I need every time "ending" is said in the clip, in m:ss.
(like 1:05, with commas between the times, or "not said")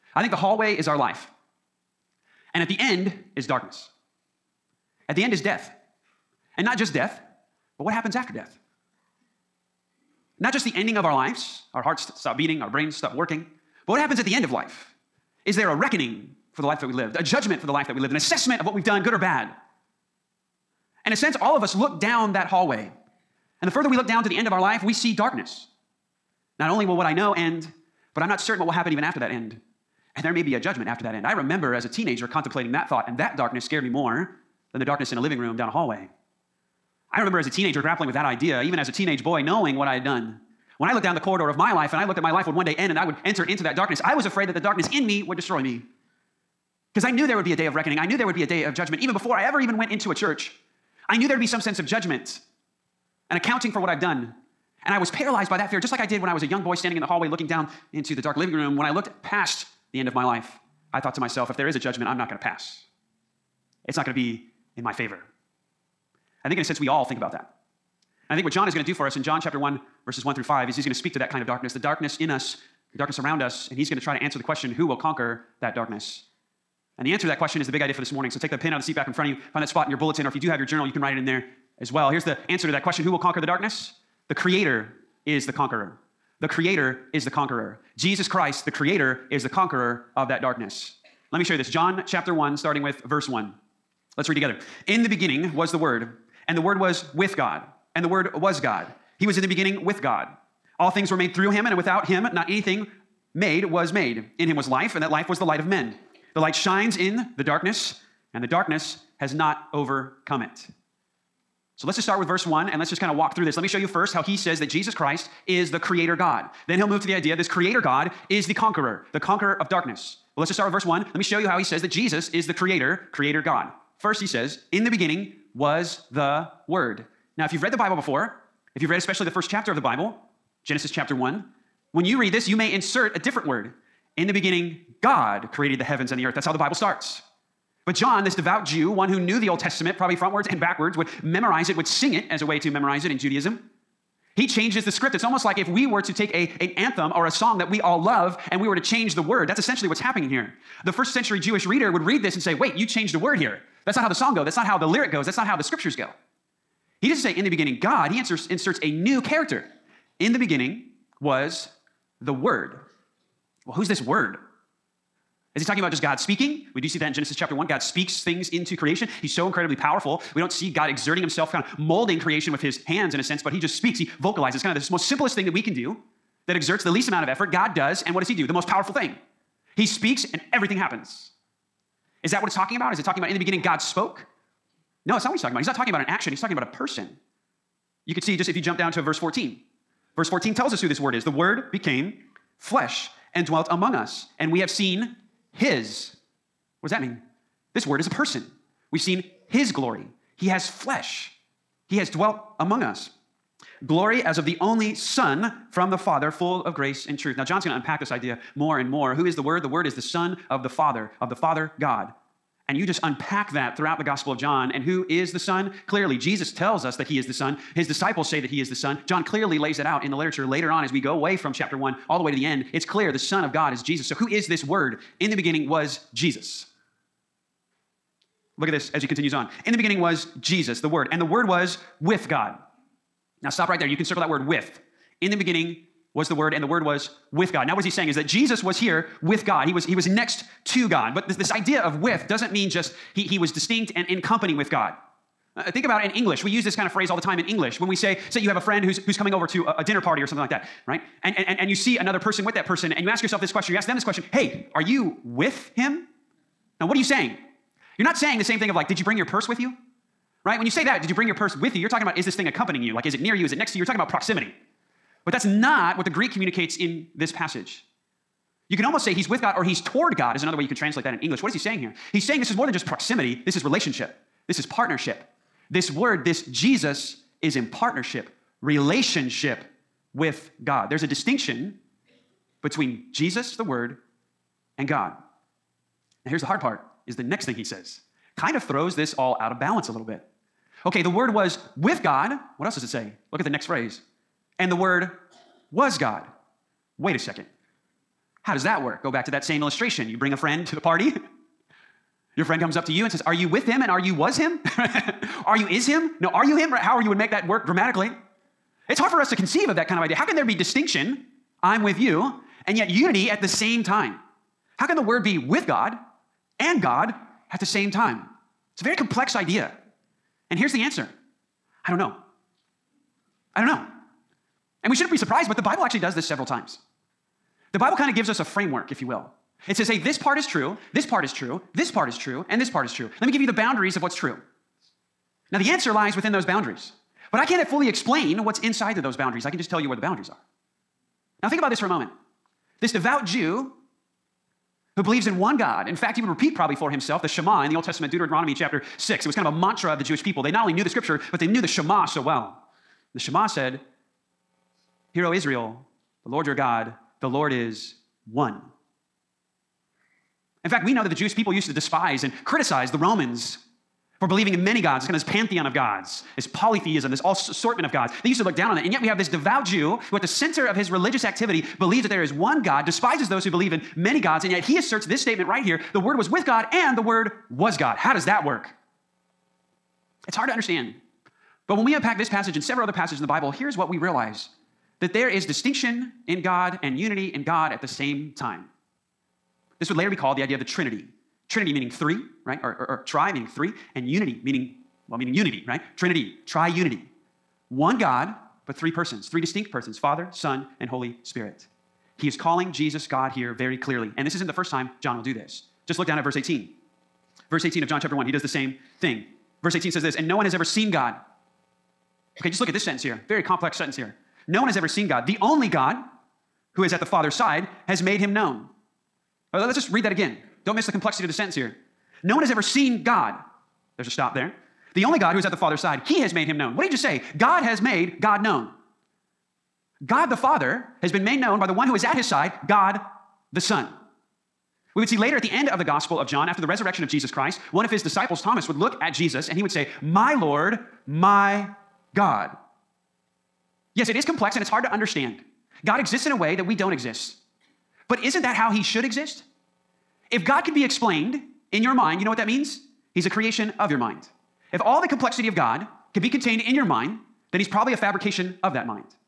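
0:10.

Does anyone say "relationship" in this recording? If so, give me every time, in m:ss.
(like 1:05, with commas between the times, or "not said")
4:33, 4:38.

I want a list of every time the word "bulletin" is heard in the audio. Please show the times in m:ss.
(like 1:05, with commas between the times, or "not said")
1:19.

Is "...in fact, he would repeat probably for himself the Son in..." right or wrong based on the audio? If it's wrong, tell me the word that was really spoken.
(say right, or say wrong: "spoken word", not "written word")
wrong: "Shema", not "Son".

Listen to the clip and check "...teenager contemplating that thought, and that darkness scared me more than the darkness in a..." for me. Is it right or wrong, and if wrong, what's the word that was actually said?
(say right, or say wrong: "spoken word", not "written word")
right.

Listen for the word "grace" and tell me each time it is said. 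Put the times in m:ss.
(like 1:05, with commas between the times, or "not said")
3:26.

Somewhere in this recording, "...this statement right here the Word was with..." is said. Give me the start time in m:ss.
6:15.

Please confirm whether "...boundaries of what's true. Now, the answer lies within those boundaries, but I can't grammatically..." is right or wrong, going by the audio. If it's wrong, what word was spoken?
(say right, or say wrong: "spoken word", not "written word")
wrong: "fully", not "grammatically".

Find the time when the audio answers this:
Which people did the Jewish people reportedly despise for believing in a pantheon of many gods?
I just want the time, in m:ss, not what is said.
6:02.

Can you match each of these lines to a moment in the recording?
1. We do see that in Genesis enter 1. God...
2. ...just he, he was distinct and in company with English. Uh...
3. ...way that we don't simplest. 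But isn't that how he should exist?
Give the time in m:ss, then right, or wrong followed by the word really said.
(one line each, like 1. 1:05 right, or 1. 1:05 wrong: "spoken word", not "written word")
1. 2:46 wrong: "chapter", not "enter"
2. 4:02 wrong: "God", not "English"
3. 7:26 wrong: "exist", not "simplest".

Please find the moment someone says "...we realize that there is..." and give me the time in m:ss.
6:23.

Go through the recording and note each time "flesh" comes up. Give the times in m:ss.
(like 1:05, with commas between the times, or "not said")
3:12, 3:20.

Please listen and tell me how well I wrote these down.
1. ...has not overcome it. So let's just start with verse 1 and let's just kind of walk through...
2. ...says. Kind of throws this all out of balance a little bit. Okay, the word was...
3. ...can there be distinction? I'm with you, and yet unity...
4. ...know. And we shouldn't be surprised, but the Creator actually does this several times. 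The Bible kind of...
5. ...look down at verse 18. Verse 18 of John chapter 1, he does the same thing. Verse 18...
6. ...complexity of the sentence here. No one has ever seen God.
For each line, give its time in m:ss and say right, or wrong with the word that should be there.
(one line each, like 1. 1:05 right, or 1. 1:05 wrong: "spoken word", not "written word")
1. 1:49 right
2. 4:47 right
3. 5:10 right
4. 5:23 wrong: "Bible", not "Creator"
5. 6:45 right
6. 7:00 right.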